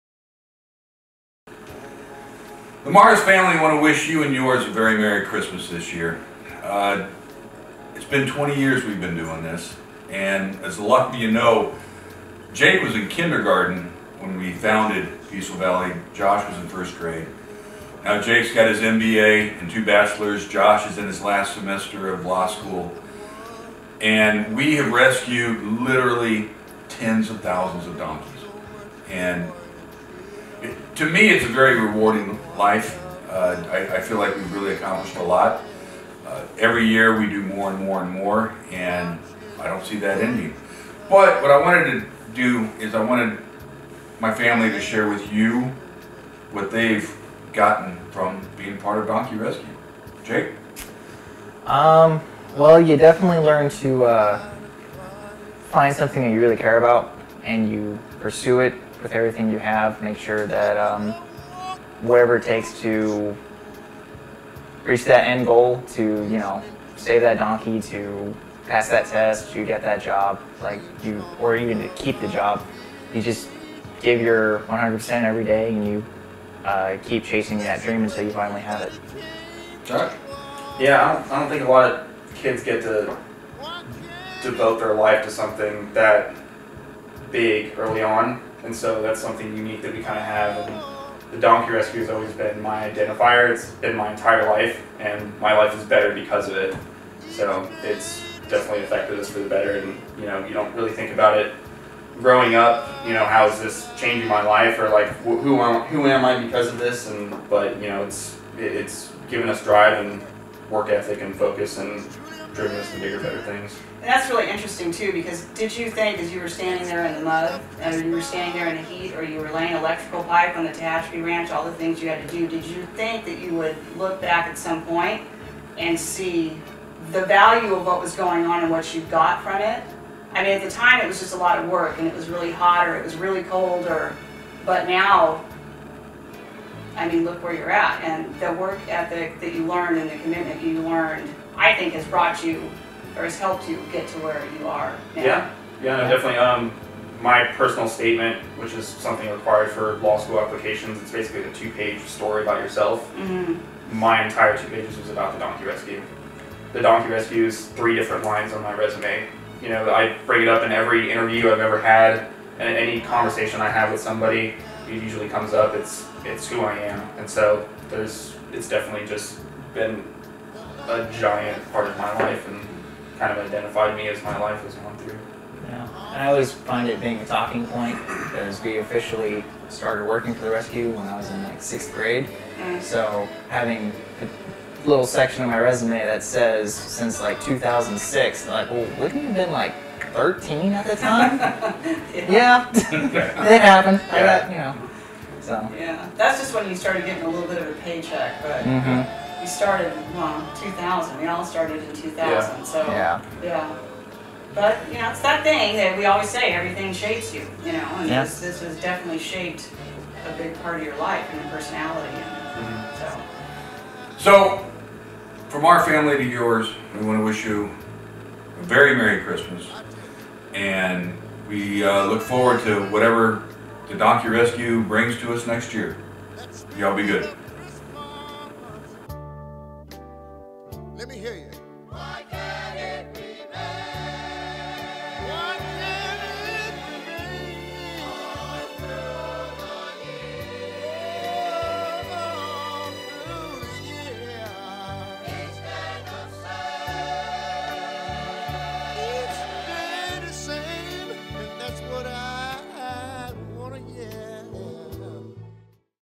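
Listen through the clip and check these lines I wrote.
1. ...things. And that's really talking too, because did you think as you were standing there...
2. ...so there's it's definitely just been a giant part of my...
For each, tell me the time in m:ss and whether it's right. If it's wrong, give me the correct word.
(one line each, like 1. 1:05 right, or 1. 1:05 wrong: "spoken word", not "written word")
1. 1:53 wrong: "interesting", not "talking"
2. 2:47 right.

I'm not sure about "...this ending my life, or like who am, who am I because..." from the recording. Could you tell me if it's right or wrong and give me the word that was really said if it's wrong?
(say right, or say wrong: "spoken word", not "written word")
wrong: "changing", not "ending".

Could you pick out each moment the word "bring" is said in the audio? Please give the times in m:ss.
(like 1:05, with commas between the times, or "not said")
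2:40, 3:44.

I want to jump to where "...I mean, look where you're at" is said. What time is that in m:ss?
2:17.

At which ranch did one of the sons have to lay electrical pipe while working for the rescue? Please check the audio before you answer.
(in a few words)
Tehachapi Ranch.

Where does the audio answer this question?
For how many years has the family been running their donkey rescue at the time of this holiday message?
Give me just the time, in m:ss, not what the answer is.
0:08.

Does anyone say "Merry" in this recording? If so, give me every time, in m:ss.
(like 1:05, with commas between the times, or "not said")
0:04, 3:38.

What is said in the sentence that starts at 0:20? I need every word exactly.
Josh is in his last semester of law school.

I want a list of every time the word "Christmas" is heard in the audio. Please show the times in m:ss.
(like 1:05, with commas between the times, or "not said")
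0:05, 3:39.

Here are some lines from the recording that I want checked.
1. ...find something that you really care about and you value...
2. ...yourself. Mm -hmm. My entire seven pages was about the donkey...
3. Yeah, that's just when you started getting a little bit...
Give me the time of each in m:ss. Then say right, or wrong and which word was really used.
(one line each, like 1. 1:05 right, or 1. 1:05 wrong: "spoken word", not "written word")
1. 0:55 wrong: "pursue", not "value"
2. 2:32 wrong: "two", not "seven"
3. 3:15 right.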